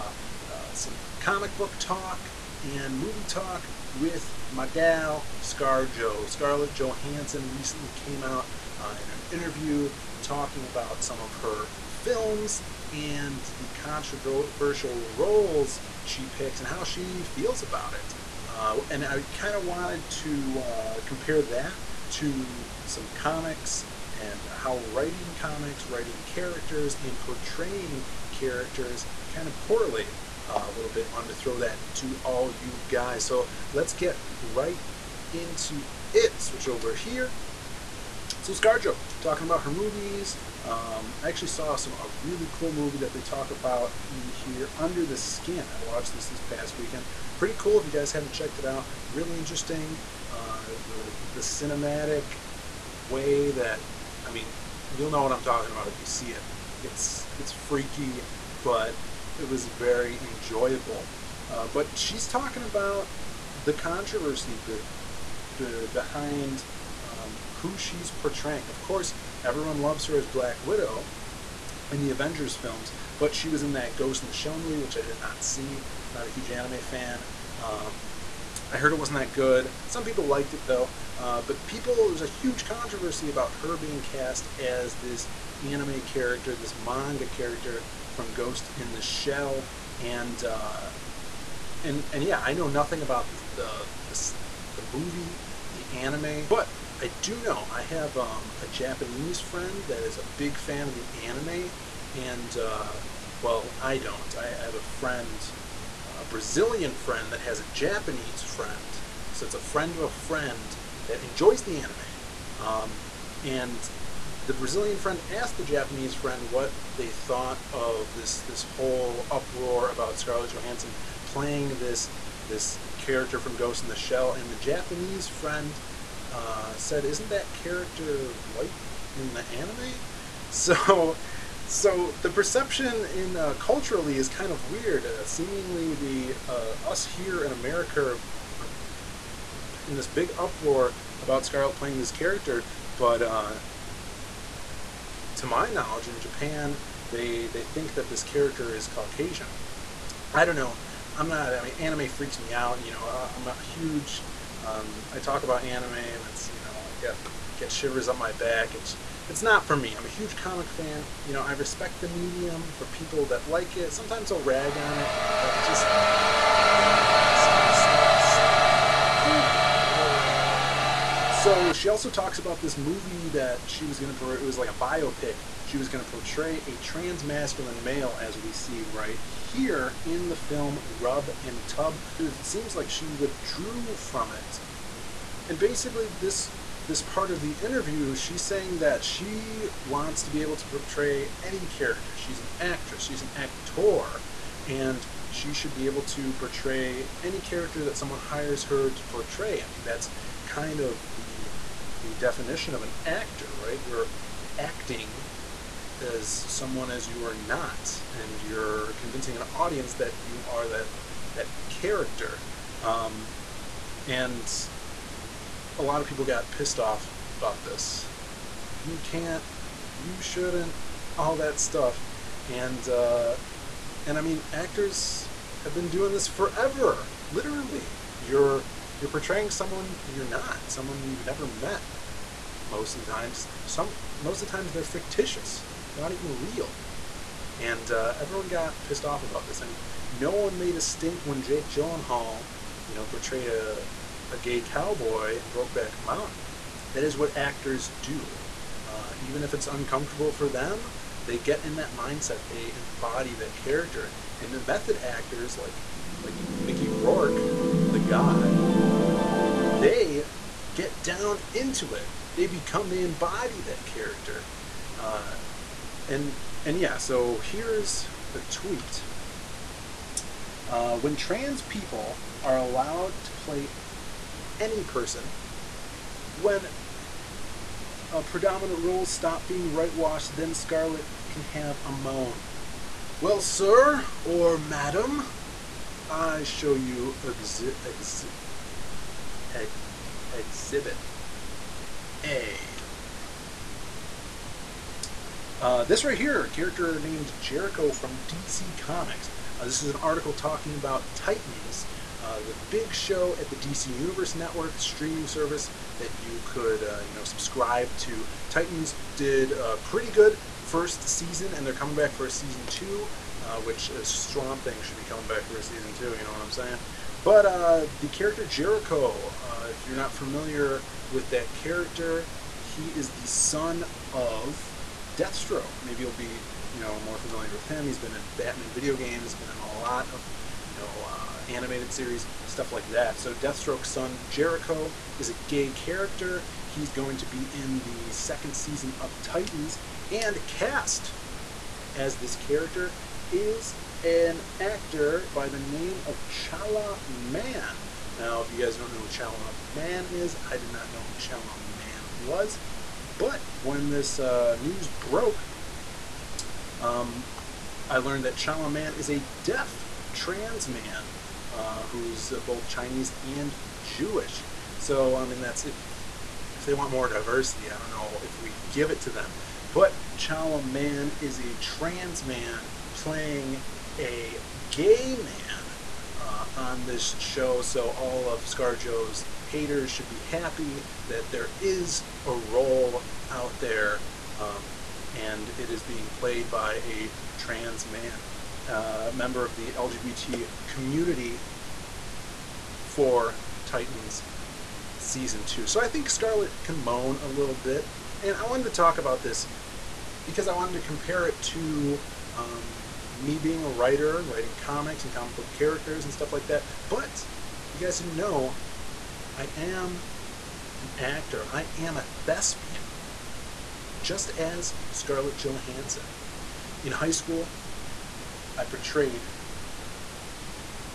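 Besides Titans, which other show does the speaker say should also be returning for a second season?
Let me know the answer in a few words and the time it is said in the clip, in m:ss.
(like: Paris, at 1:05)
Swamp Thing, at 5:14.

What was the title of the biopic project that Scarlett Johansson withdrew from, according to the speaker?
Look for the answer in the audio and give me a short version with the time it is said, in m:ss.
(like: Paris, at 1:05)
Rub and Tug, at 3:00.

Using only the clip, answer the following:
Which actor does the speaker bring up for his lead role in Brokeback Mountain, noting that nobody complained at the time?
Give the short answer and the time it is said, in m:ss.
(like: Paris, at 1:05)
Jake Gyllenhaal, at 4:01.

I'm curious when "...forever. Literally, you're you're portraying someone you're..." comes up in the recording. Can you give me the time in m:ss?
3:46.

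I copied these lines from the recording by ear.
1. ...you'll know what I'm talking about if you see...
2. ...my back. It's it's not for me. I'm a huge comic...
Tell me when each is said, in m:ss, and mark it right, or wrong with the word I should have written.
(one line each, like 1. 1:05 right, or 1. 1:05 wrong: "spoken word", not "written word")
1. 0:54 right
2. 2:38 right.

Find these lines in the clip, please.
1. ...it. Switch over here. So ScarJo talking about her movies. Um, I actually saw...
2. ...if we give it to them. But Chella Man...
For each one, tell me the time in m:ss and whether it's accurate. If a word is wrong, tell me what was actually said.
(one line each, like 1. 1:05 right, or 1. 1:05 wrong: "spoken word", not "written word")
1. 0:36 right
2. 6:08 right.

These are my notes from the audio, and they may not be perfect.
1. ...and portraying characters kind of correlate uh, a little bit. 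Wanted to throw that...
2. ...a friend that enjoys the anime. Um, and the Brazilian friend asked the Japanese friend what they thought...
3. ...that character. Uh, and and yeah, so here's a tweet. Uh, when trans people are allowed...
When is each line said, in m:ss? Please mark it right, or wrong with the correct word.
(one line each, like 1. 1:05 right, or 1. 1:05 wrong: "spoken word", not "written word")
1. 0:27 right
2. 1:50 right
3. 4:23 right.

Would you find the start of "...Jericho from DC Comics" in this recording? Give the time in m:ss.
4:57.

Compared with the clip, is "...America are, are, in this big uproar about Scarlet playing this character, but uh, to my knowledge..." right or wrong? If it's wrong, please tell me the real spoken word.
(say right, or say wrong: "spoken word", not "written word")
right.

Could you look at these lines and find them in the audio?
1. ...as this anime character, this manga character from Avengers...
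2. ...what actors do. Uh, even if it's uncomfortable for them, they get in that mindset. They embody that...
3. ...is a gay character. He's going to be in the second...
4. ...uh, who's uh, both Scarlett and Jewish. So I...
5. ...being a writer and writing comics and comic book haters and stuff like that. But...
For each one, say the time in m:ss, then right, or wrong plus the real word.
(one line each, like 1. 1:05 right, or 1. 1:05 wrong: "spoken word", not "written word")
1. 1:24 wrong: "Ghost", not "Avengers"
2. 4:07 right
3. 5:35 right
4. 6:01 wrong: "Chinese", not "Scarlett"
5. 6:43 wrong: "characters", not "haters".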